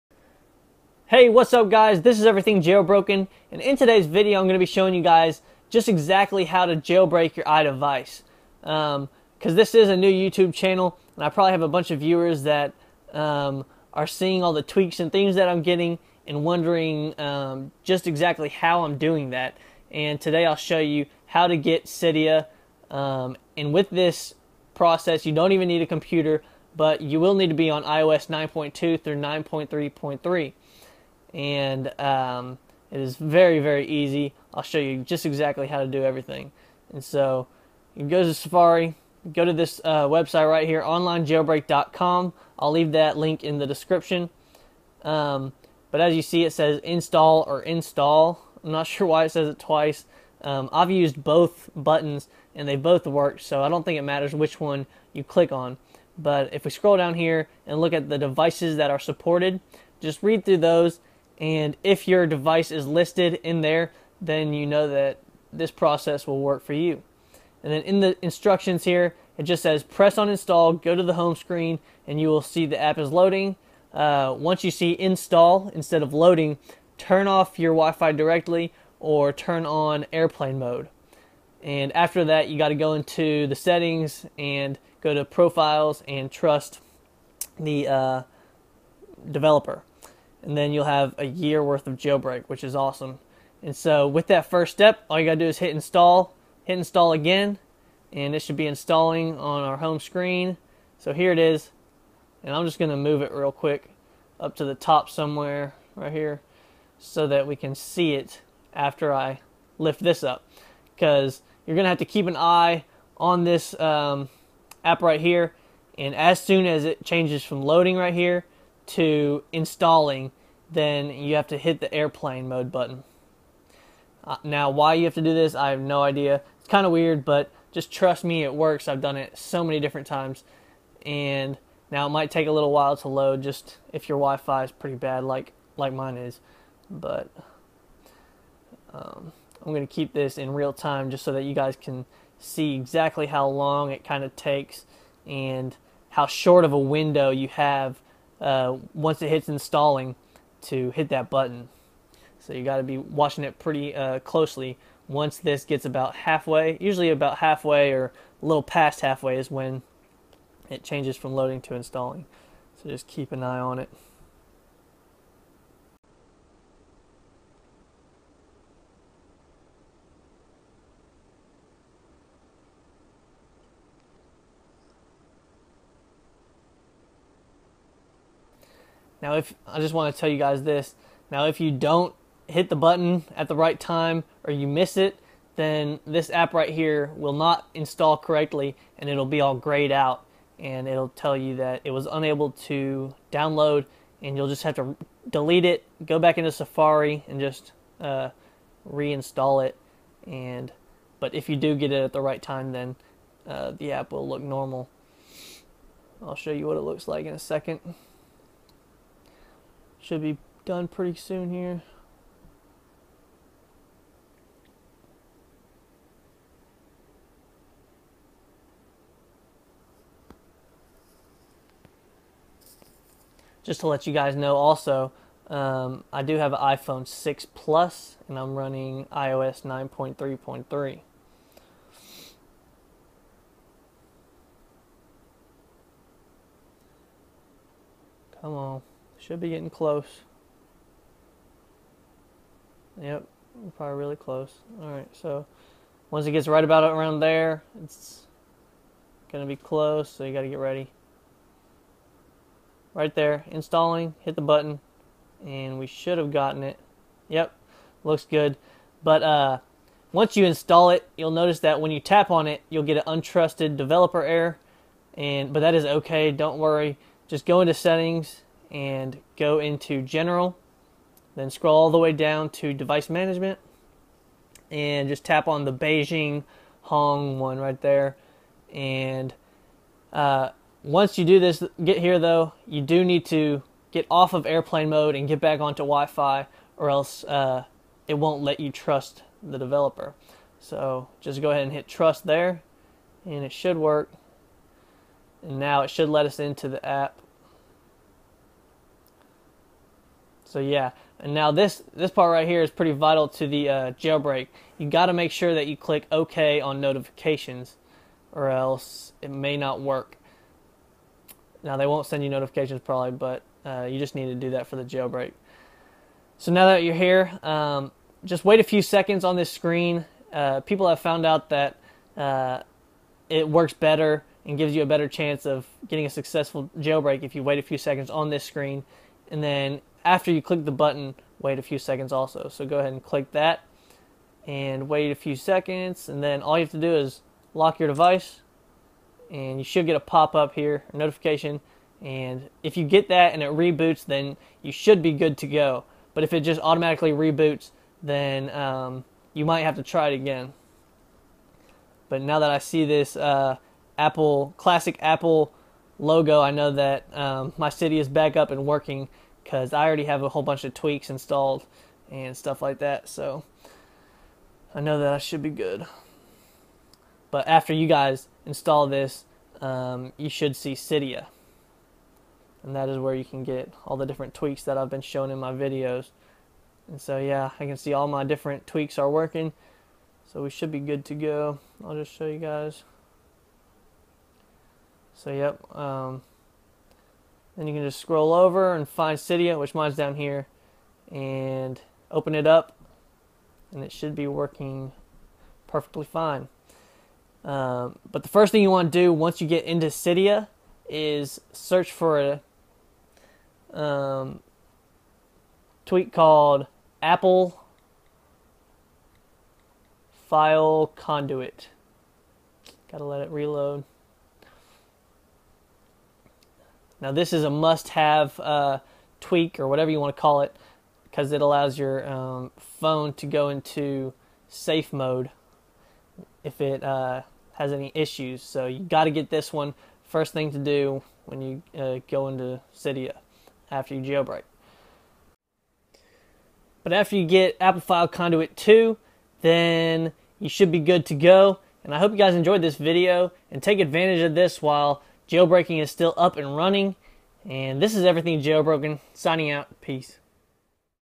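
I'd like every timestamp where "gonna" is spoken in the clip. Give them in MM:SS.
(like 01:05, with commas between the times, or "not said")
01:42, 01:51.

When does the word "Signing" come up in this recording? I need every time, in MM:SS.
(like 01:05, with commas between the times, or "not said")
07:29.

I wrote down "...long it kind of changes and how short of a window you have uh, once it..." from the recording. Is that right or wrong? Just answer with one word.
wrong.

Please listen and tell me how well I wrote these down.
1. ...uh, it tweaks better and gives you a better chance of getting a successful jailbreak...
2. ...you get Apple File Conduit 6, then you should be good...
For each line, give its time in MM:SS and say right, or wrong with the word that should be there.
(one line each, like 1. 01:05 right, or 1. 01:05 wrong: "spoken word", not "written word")
1. 05:22 wrong: "works", not "tweaks"
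2. 07:17 wrong: "2", not "6".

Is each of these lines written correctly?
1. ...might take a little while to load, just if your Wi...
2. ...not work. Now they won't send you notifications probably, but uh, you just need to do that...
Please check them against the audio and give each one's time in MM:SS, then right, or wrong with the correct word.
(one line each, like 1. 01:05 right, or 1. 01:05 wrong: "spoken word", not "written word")
1. 02:12 right
2. 05:09 right.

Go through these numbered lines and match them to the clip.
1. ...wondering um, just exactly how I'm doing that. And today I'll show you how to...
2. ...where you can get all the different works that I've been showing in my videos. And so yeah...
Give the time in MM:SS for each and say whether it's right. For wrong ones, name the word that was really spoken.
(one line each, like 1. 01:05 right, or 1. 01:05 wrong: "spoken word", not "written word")
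1. 00:16 right
2. 06:12 wrong: "tweaks", not "works".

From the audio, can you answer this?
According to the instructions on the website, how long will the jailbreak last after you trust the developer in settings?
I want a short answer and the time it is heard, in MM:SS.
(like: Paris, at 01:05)
a year, at 01:31.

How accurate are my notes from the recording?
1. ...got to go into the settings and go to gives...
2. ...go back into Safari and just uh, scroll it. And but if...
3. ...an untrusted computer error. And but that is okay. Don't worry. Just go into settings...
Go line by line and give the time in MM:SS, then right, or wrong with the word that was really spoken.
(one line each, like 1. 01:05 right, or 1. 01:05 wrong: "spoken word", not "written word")
1. 01:22 wrong: "profiles", not "gives"
2. 03:16 wrong: "reinstall", not "scroll"
3. 04:22 wrong: "developer", not "computer".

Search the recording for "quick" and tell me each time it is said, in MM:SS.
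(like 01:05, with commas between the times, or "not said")
01:43.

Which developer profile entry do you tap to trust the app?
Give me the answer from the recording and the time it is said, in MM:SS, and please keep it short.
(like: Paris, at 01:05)
Beijing Hong, at 04:35.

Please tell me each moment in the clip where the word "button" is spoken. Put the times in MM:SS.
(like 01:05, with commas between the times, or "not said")
00:51, 02:02, 02:31, 03:02, 04:14, 05:30.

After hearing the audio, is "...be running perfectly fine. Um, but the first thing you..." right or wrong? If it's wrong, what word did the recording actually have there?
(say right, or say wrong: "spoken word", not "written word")
wrong: "working", not "running".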